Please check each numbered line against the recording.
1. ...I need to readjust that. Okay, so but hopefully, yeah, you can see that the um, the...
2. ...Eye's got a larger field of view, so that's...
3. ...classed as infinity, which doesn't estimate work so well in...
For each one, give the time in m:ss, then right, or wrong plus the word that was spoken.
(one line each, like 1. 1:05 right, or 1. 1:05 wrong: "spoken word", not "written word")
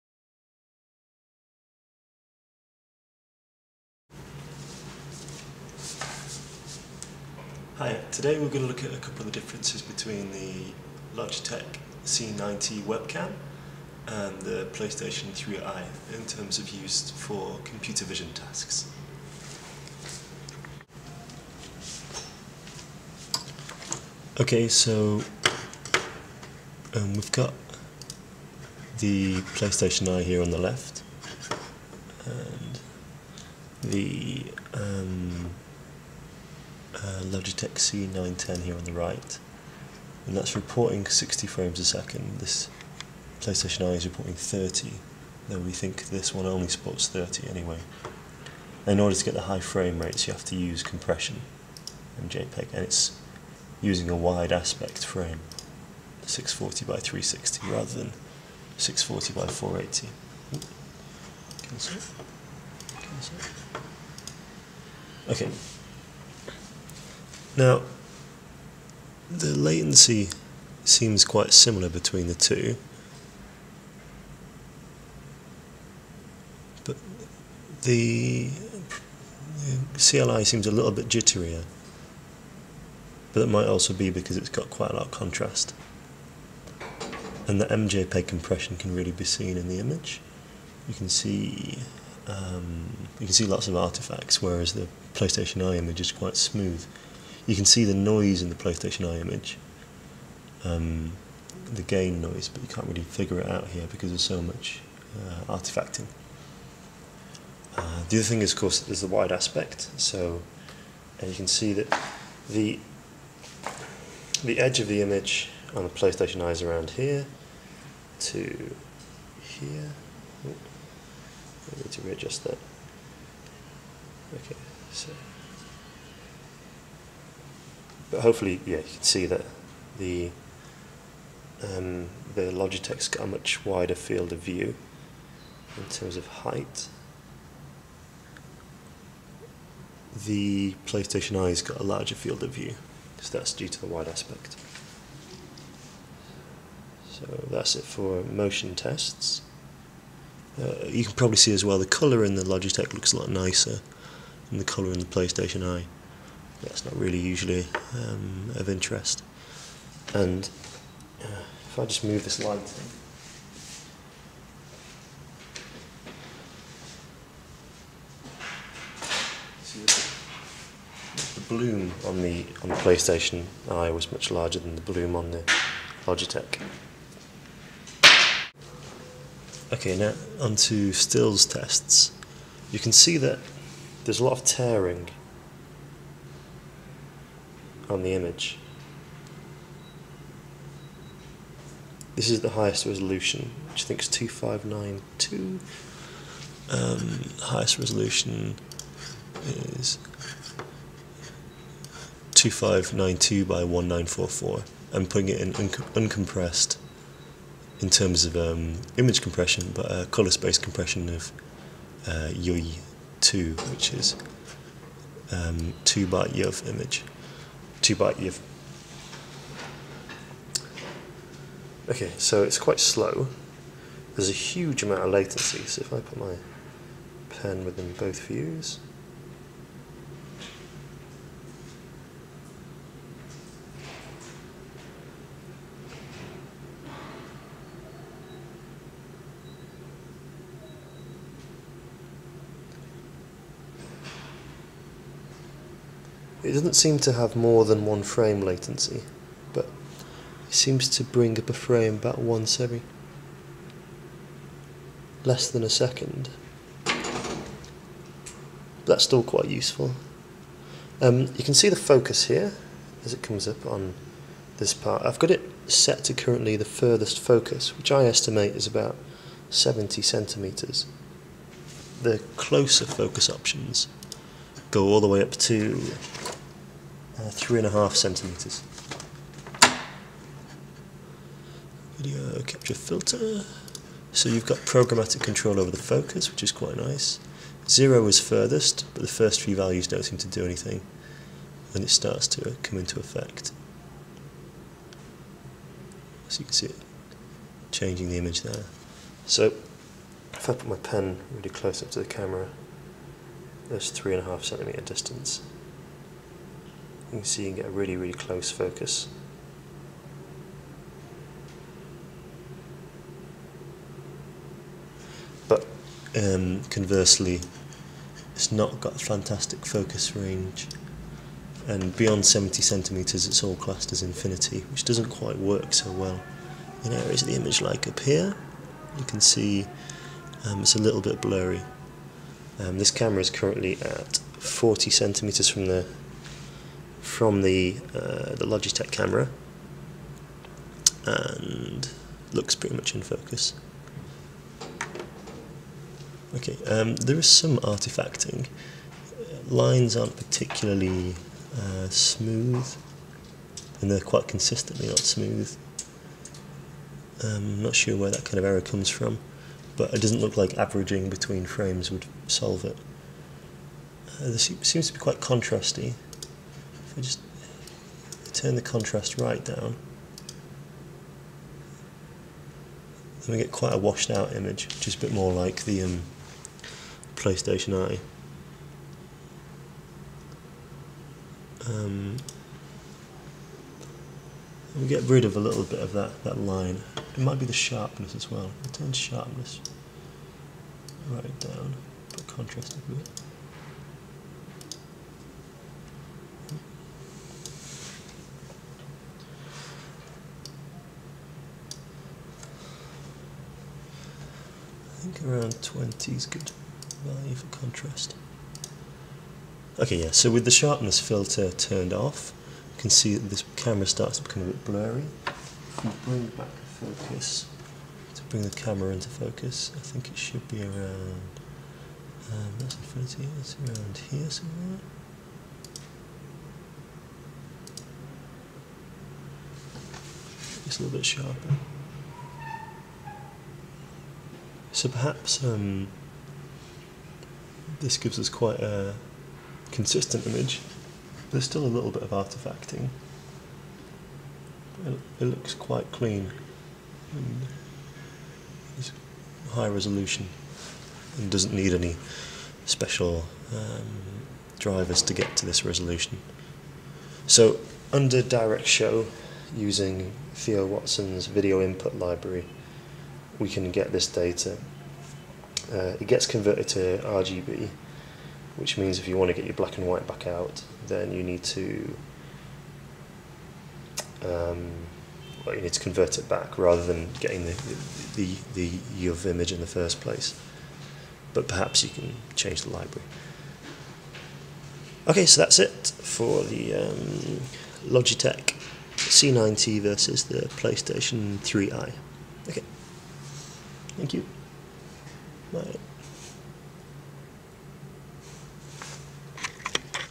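1. 2:01 right
2. 2:21 right
3. 5:23 wrong: "quite", not "estimate".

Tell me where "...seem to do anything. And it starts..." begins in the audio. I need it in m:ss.
4:50.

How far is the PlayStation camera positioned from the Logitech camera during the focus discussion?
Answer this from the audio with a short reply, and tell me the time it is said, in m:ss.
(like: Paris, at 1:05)
40 centimeters, at 5:34.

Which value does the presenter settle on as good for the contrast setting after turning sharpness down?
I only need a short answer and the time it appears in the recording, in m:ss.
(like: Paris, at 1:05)
20, at 6:45.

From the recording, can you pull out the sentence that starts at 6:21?
Um, we get rid of a little bit of that, that line.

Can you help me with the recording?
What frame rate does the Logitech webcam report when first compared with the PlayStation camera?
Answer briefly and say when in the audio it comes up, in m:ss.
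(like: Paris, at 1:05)
60 frames a second, at 0:41.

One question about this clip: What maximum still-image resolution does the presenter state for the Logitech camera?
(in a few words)
2592 by 1944.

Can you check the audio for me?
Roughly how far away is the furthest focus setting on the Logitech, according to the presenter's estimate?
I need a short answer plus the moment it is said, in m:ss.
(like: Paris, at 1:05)
70 centimeters, at 4:28.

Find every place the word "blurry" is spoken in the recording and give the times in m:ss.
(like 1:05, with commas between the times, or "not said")
5:31, 6:54.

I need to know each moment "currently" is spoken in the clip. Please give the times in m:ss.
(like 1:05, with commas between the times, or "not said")
4:26, 5:33.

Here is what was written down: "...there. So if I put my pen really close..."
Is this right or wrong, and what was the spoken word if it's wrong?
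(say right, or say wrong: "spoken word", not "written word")
right.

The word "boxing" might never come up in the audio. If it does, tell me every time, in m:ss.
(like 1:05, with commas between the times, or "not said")
not said.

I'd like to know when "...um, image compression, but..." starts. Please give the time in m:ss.
3:28.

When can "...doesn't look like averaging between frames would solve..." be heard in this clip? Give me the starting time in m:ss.
6:00.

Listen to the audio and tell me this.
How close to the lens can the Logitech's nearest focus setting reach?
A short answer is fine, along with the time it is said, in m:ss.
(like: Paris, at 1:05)
3.5 centimeters, at 4:37.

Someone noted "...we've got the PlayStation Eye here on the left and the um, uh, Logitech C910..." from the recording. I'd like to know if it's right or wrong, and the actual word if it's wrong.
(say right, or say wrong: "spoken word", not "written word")
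right.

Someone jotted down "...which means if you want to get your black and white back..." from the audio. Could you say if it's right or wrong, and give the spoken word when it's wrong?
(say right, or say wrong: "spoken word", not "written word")
right.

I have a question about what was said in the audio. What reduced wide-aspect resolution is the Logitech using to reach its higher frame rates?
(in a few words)
640 by 360.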